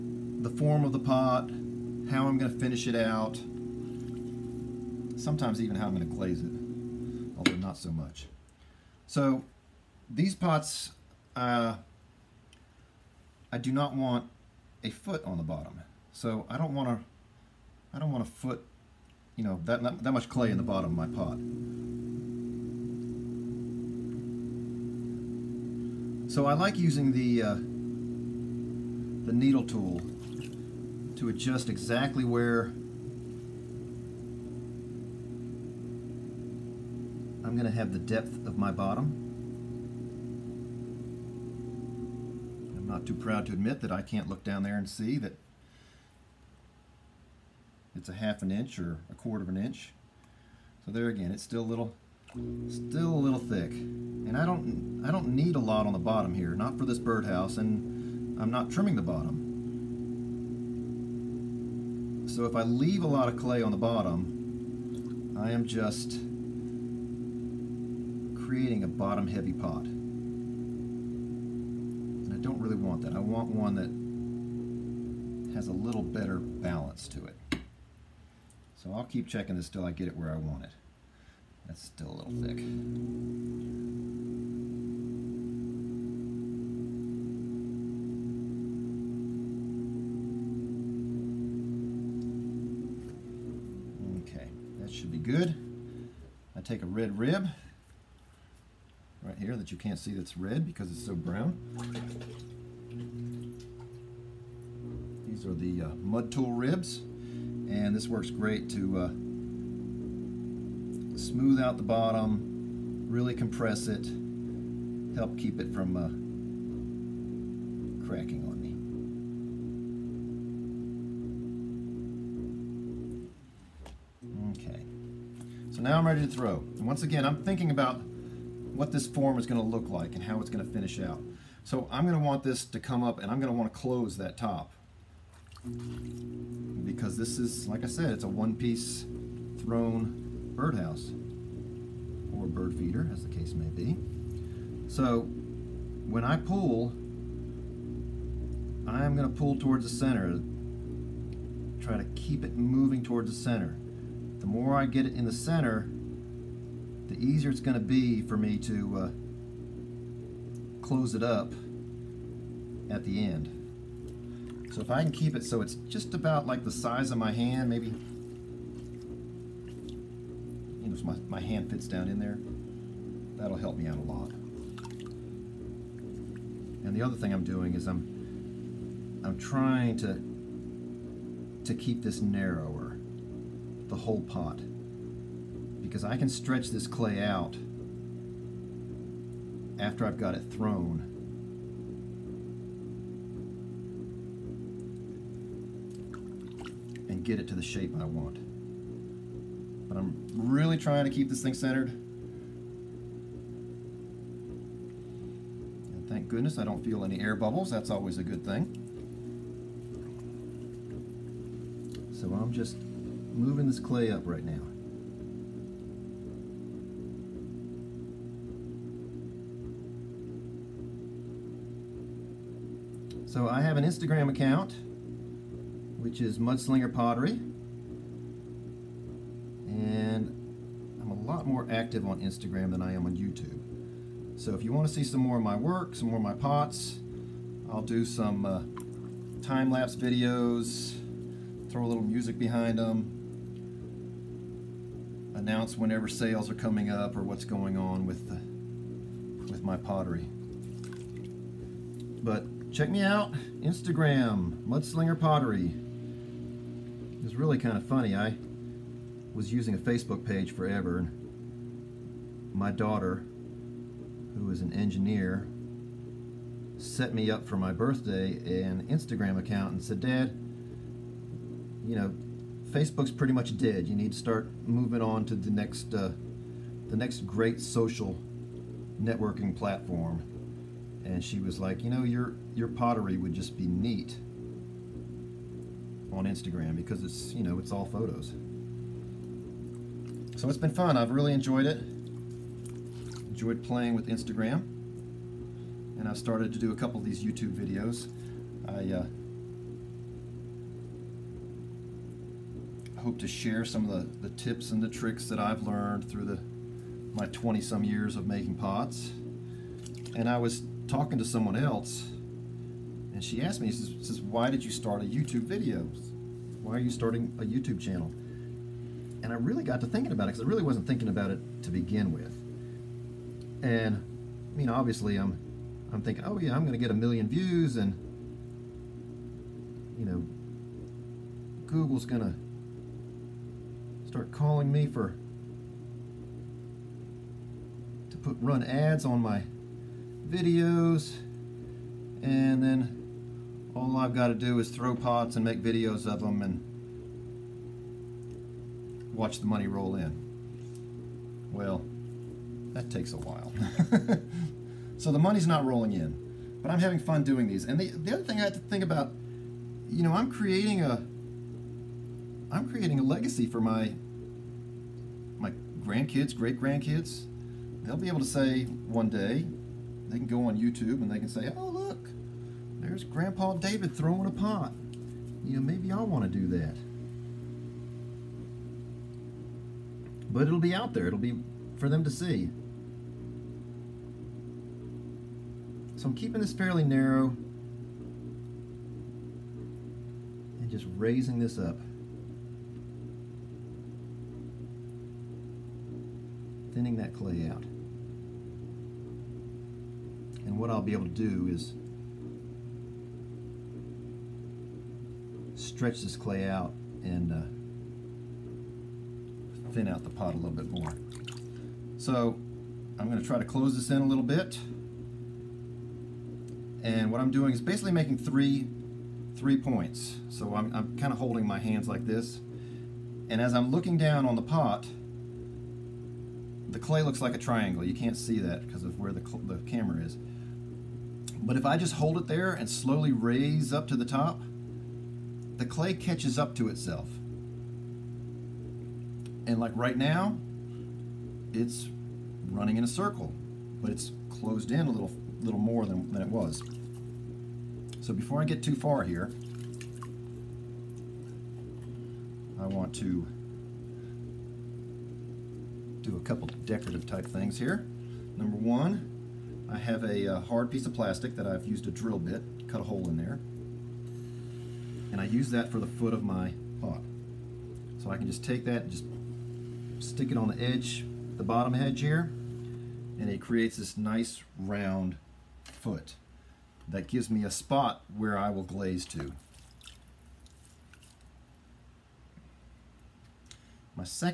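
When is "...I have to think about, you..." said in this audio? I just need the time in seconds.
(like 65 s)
358 s.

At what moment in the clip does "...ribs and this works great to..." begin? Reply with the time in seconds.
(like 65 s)
106 s.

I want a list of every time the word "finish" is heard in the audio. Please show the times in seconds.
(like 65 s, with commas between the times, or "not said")
2 s, 130 s.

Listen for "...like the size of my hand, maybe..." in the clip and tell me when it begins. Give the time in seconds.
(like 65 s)
166 s.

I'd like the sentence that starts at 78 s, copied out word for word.
So I'll keep checking this till I get it where I want it.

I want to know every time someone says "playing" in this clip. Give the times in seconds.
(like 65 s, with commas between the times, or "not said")
293 s.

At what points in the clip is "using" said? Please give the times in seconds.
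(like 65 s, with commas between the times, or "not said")
26 s, 259 s.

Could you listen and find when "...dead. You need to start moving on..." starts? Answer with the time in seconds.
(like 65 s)
273 s.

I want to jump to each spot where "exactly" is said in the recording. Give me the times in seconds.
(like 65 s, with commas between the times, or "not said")
31 s.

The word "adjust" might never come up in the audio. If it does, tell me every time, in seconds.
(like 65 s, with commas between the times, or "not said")
31 s.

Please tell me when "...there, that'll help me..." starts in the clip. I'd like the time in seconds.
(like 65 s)
172 s.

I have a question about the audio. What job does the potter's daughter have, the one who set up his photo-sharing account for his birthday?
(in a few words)
engineer.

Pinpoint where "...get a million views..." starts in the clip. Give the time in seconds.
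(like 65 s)
326 s.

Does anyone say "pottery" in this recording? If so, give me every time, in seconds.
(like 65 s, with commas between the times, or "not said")
226 s, 249 s, 255 s, 282 s.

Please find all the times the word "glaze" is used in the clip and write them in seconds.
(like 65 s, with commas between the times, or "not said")
6 s, 478 s.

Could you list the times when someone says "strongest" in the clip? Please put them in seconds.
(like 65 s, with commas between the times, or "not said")
not said.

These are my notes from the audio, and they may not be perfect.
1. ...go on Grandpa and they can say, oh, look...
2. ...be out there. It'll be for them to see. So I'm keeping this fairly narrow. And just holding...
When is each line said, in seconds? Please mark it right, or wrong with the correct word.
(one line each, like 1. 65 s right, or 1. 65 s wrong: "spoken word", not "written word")
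1. 370 s wrong: "YouTube", not "Grandpa"
2. 380 s wrong: "raising", not "holding".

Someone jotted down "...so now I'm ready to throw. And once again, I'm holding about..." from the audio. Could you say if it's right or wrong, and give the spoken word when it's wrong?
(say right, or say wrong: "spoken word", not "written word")
wrong: "thinking", not "holding".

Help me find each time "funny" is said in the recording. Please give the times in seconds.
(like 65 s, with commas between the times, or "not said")
257 s.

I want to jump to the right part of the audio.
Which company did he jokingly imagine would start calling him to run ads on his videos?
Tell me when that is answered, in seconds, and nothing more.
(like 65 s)
331 s.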